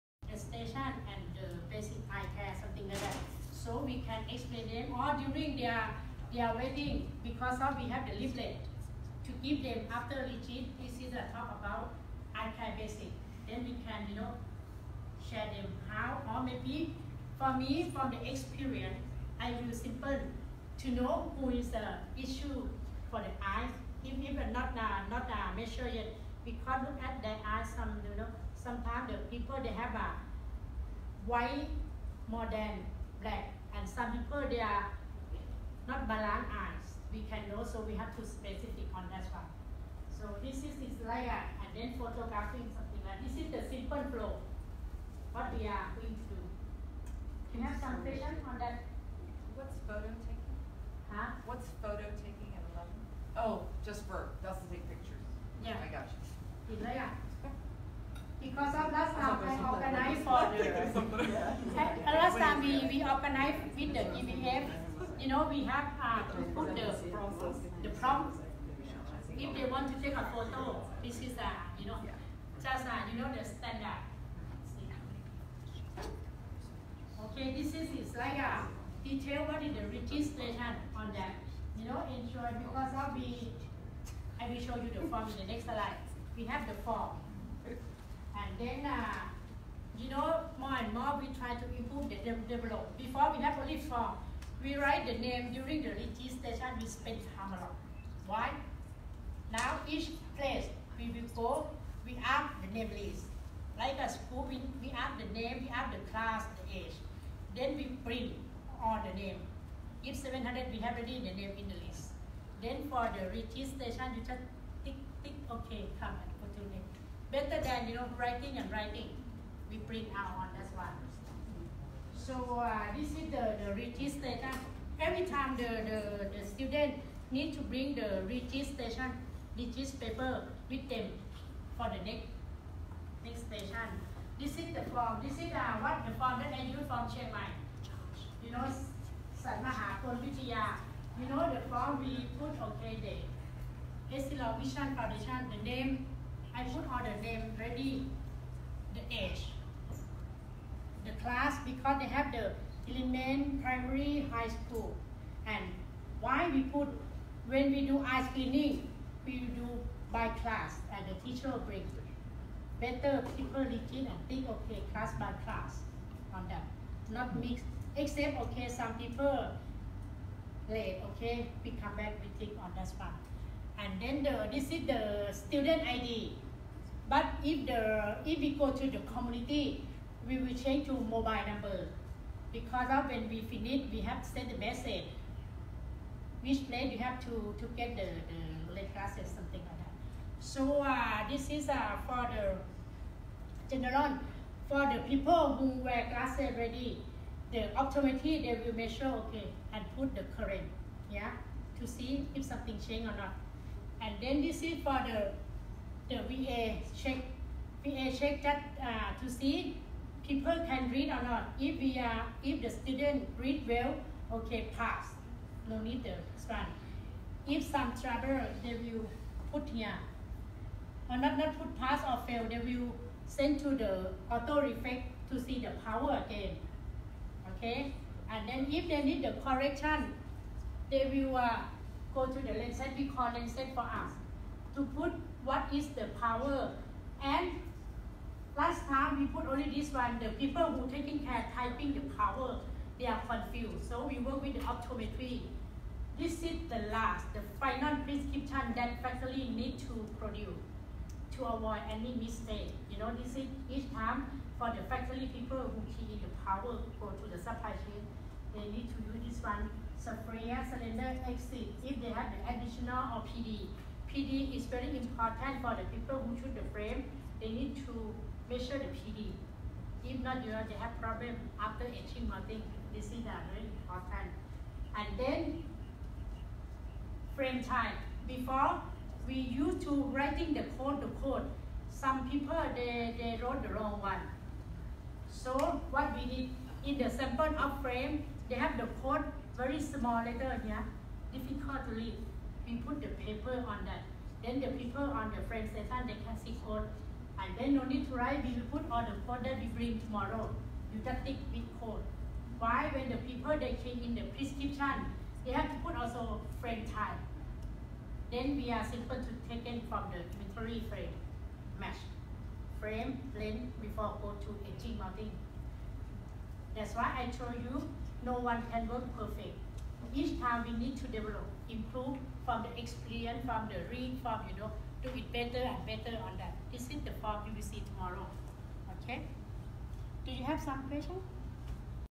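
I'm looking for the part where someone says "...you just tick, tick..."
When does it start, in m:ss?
1:54.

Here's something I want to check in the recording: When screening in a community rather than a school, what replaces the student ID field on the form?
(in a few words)
Mobile number.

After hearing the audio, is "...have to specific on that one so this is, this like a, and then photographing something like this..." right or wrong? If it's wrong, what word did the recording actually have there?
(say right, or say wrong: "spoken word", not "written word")
right.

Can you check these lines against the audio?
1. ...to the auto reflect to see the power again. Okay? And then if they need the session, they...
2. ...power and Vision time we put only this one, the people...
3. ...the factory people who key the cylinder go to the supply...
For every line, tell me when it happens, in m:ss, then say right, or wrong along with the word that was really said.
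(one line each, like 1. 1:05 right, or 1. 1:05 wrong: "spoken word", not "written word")
1. 3:43 wrong: "correction", not "session"
2. 3:56 wrong: "Last", not "Vision"
3. 4:14 wrong: "power", not "cylinder".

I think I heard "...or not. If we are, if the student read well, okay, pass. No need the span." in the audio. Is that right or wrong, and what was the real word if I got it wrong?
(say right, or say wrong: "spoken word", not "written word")
right.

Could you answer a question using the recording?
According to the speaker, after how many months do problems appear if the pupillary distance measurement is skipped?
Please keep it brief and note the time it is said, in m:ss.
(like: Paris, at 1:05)
18, at 4:31.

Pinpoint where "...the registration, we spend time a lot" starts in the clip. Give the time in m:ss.
1:35.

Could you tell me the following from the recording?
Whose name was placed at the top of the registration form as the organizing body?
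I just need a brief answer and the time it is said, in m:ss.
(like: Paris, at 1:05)
Essilor Vision Foundation, at 2:24.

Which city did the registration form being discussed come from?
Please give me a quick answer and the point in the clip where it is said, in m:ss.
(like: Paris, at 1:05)
Chiang Mai, at 2:17.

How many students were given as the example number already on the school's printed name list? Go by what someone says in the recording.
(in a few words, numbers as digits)
700.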